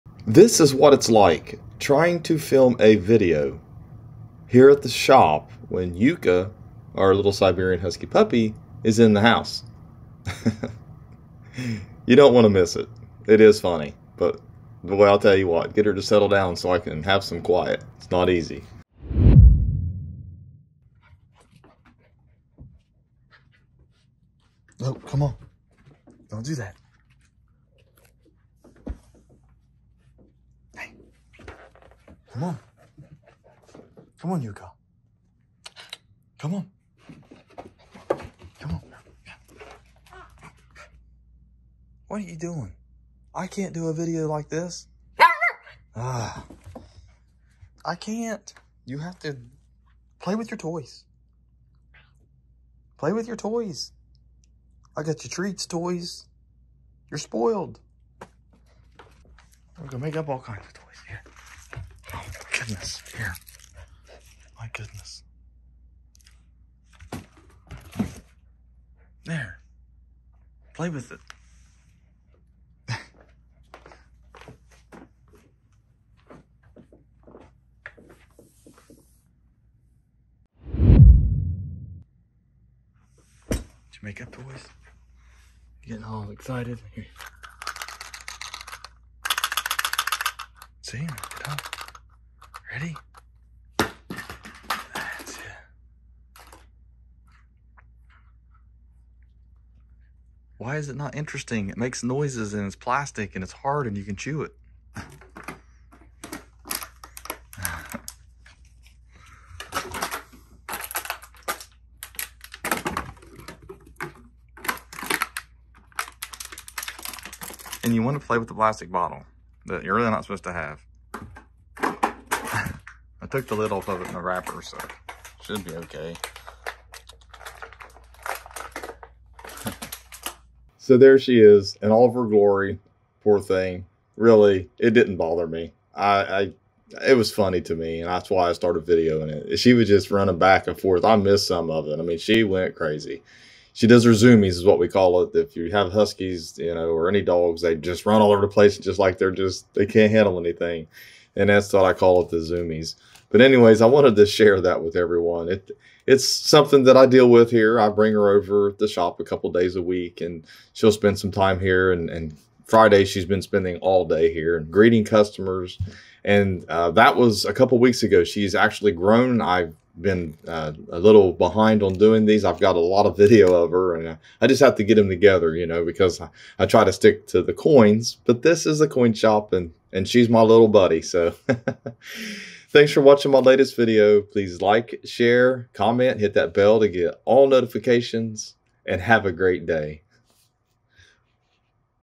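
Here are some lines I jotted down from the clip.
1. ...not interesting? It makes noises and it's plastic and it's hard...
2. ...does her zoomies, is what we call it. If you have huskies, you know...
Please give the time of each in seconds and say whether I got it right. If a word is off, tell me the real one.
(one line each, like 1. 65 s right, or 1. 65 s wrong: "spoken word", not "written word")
1. 100 s right
2. 143 s right.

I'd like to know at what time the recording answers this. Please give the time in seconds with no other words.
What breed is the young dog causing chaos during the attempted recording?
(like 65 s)
7 s.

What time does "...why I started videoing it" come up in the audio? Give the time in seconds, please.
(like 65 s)
138 s.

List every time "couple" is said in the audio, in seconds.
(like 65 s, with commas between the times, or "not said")
159 s, 167 s.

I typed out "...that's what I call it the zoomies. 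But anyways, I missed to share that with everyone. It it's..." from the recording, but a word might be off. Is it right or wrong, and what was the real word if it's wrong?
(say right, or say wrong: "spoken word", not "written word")
wrong: "wanted", not "missed".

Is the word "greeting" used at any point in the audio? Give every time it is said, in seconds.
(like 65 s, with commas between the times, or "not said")
164 s.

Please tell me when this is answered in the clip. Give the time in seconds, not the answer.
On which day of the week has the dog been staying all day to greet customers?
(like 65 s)
162 s.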